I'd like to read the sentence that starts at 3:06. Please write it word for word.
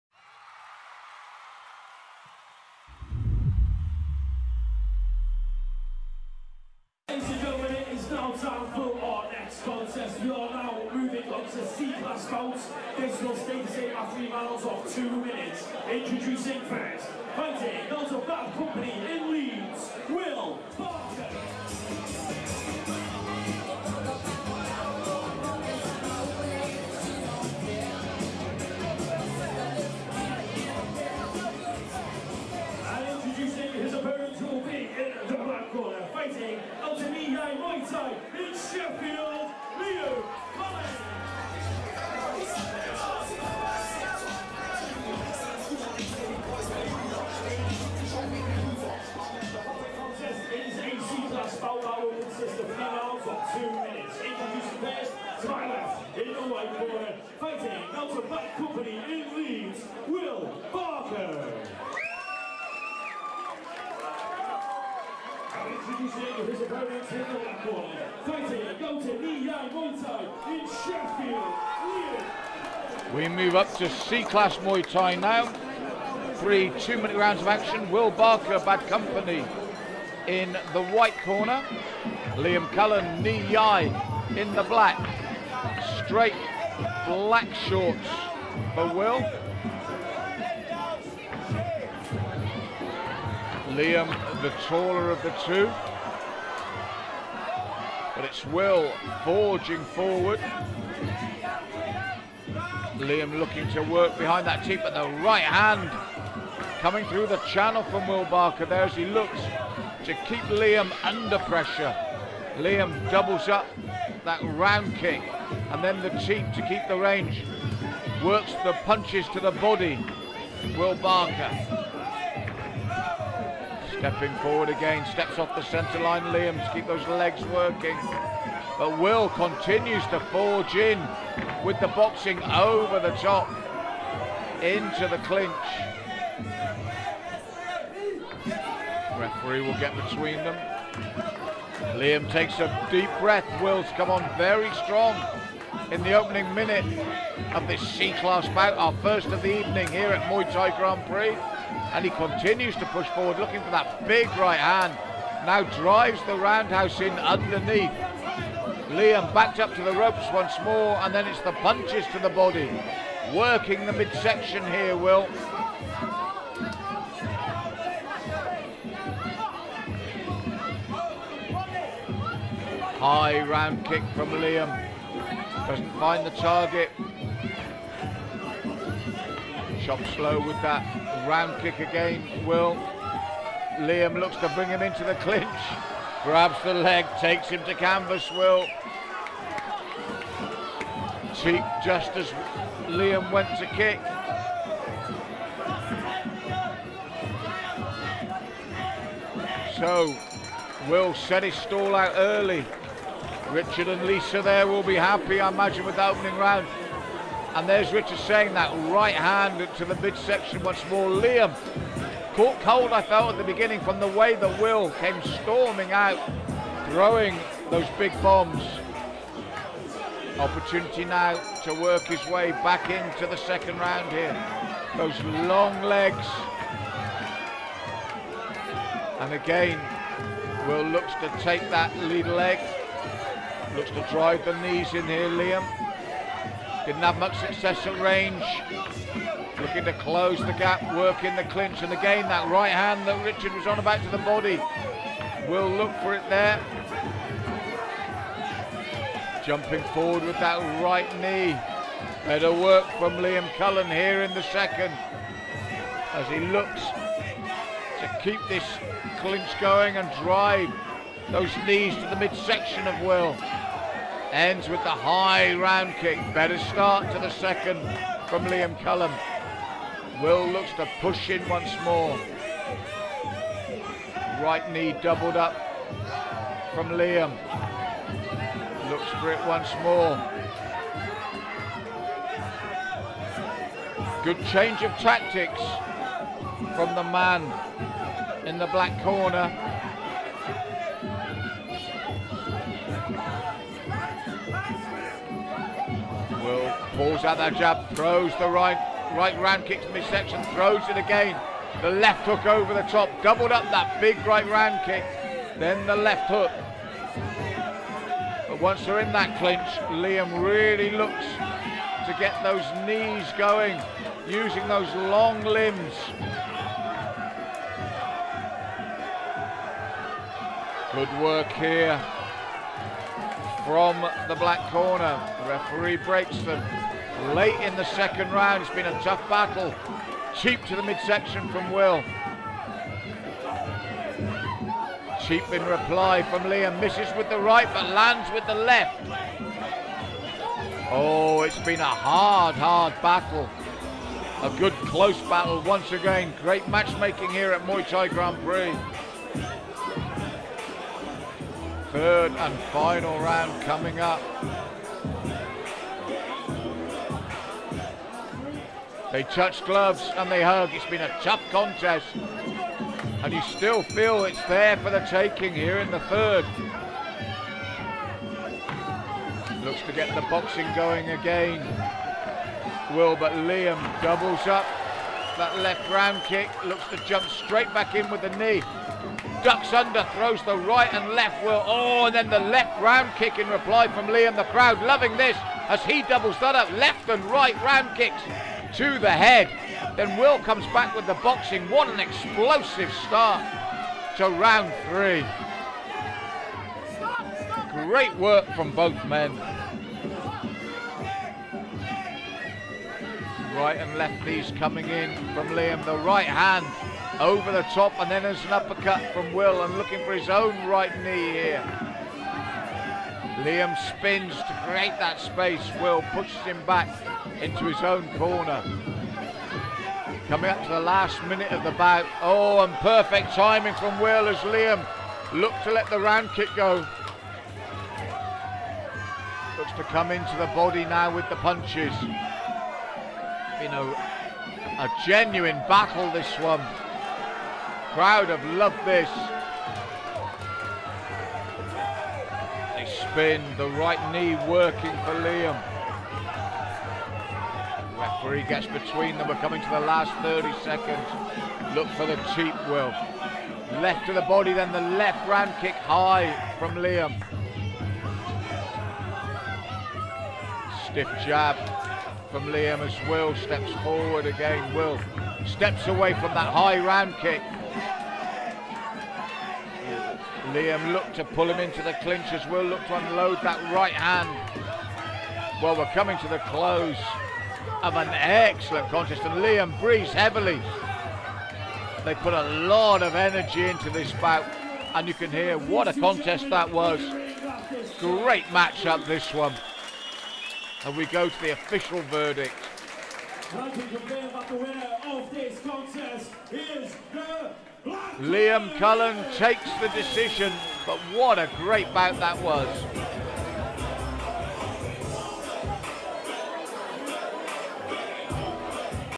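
Grabs the leg, takes him to canvas, Will.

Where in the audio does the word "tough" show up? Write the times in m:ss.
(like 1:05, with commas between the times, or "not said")
5:29, 6:01.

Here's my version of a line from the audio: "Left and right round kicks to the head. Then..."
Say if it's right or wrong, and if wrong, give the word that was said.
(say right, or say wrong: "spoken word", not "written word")
right.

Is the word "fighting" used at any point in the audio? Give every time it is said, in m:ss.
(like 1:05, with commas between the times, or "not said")
0:17, 1:08.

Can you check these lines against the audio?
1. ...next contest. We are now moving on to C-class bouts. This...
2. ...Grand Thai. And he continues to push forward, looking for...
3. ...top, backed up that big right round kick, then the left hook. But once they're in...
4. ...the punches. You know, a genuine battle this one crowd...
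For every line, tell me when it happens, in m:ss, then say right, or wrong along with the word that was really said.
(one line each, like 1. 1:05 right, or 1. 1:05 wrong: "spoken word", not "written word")
1. 0:09 right
2. 2:30 wrong: "Prix", not "Thai"
3. 5:02 wrong: "doubled", not "backed"
4. 7:11 right.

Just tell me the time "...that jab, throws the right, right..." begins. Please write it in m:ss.
4:57.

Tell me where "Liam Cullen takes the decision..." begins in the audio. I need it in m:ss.
8:18.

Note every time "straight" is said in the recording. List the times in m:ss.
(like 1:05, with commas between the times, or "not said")
1:26, 6:17.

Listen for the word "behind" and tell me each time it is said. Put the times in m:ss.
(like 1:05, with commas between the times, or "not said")
1:44.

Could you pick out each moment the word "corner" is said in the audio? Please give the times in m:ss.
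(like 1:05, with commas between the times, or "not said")
1:07, 1:21, 4:49, 5:24, 6:58.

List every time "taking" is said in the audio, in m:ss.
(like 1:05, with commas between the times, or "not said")
6:05.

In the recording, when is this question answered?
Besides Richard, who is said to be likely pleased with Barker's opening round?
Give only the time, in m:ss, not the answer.
3:24.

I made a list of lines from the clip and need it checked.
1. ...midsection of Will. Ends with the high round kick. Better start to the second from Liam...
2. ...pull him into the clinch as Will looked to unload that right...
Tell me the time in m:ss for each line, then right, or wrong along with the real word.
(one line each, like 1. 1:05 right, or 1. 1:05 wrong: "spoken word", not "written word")
1. 4:22 right
2. 7:51 right.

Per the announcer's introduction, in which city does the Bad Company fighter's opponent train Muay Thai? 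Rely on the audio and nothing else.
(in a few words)
Sheffield.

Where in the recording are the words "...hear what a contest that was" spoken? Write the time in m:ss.
8:05.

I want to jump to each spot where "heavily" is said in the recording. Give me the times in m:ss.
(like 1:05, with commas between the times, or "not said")
8:00.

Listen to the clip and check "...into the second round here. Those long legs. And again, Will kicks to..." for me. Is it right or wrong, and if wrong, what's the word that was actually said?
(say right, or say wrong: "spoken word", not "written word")
wrong: "looks", not "kicks".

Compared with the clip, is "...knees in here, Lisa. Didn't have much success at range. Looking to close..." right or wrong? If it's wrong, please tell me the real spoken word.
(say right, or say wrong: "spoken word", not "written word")
wrong: "Liam", not "Lisa".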